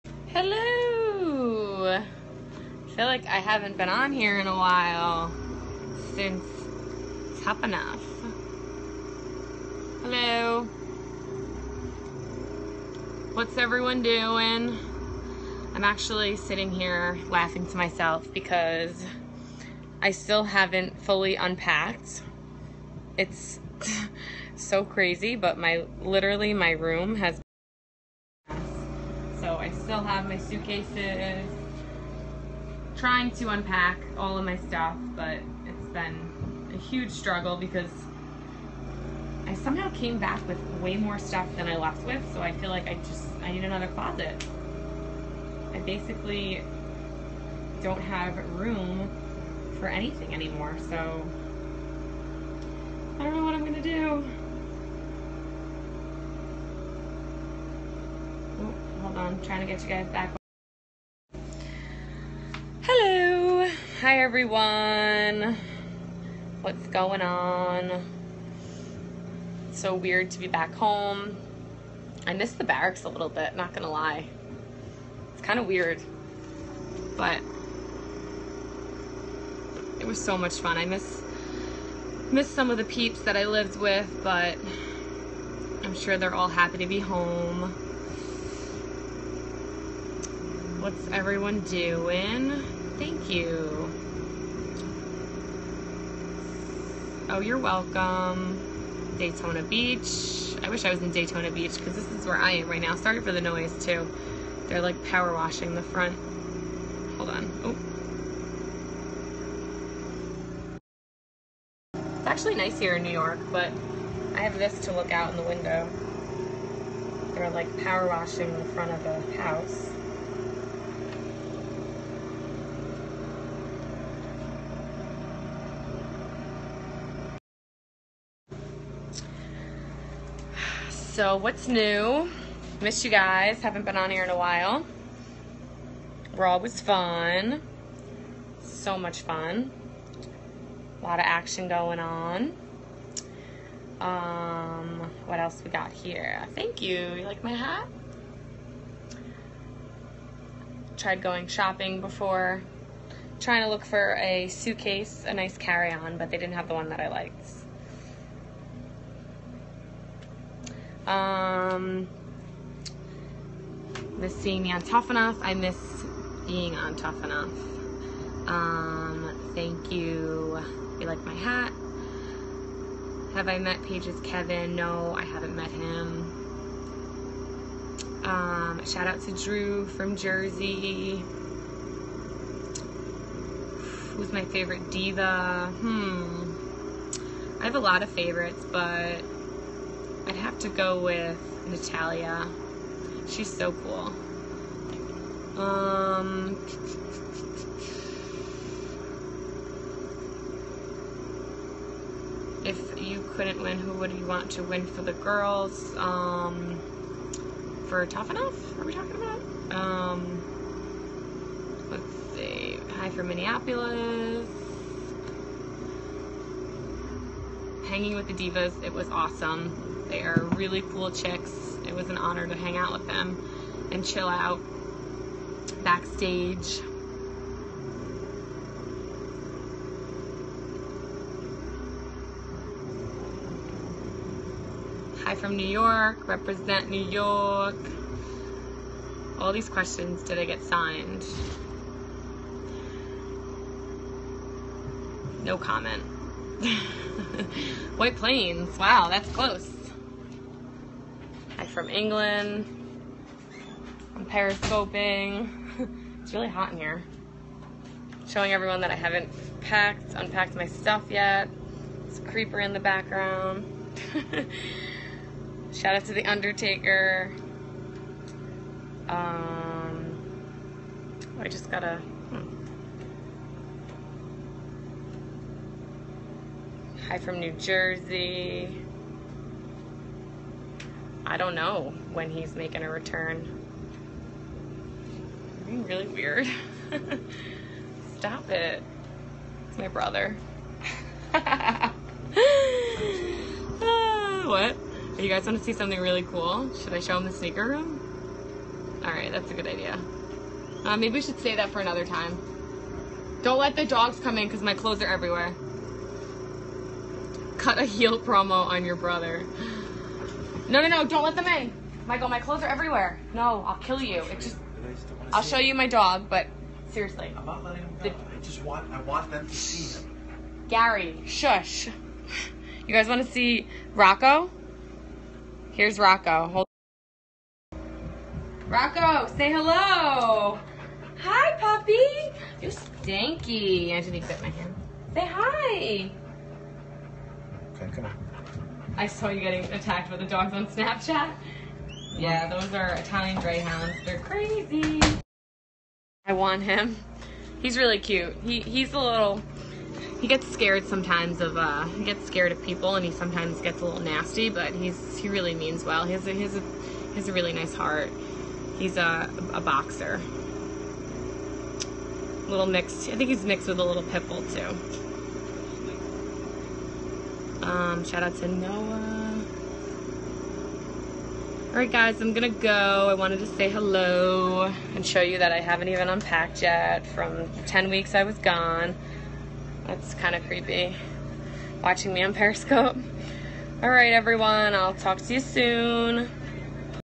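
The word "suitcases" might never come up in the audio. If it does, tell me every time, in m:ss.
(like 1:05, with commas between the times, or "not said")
0:30, 2:34.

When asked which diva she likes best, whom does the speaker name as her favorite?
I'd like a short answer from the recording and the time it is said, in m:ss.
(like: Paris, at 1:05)
Natalia, at 3:11.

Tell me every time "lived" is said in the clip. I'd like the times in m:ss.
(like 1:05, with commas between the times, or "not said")
1:23.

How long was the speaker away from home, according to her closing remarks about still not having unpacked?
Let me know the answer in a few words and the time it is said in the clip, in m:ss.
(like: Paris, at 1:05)
10 weeks, at 6:17.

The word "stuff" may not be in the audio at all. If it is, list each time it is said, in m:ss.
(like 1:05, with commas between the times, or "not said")
0:34, 0:41, 4:20.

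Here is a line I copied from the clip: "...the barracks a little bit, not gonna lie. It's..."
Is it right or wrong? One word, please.
right.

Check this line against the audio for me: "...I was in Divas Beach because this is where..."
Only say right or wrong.
wrong.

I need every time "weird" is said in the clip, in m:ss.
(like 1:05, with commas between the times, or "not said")
1:09, 1:15, 4:46.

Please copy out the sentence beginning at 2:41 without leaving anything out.
Um, miss seeing me on Tough Enough.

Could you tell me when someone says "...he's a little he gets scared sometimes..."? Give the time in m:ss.
5:48.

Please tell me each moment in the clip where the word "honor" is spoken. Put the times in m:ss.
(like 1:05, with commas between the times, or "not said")
3:42.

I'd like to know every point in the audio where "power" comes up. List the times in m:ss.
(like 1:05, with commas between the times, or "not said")
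1:45, 1:57.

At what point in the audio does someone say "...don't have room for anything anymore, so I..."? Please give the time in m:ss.
0:47.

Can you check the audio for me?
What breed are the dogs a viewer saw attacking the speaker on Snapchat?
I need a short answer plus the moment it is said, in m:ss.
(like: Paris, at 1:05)
Italian Greyhounds, at 5:42.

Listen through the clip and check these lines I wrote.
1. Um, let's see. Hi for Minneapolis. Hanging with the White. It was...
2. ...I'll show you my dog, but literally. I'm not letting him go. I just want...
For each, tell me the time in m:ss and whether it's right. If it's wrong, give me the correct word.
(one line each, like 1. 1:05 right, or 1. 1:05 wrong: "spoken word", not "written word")
1. 3:29 wrong: "Divas", not "White"
2. 5:15 wrong: "seriously", not "literally".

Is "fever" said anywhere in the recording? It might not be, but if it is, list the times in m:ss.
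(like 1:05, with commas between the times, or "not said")
not said.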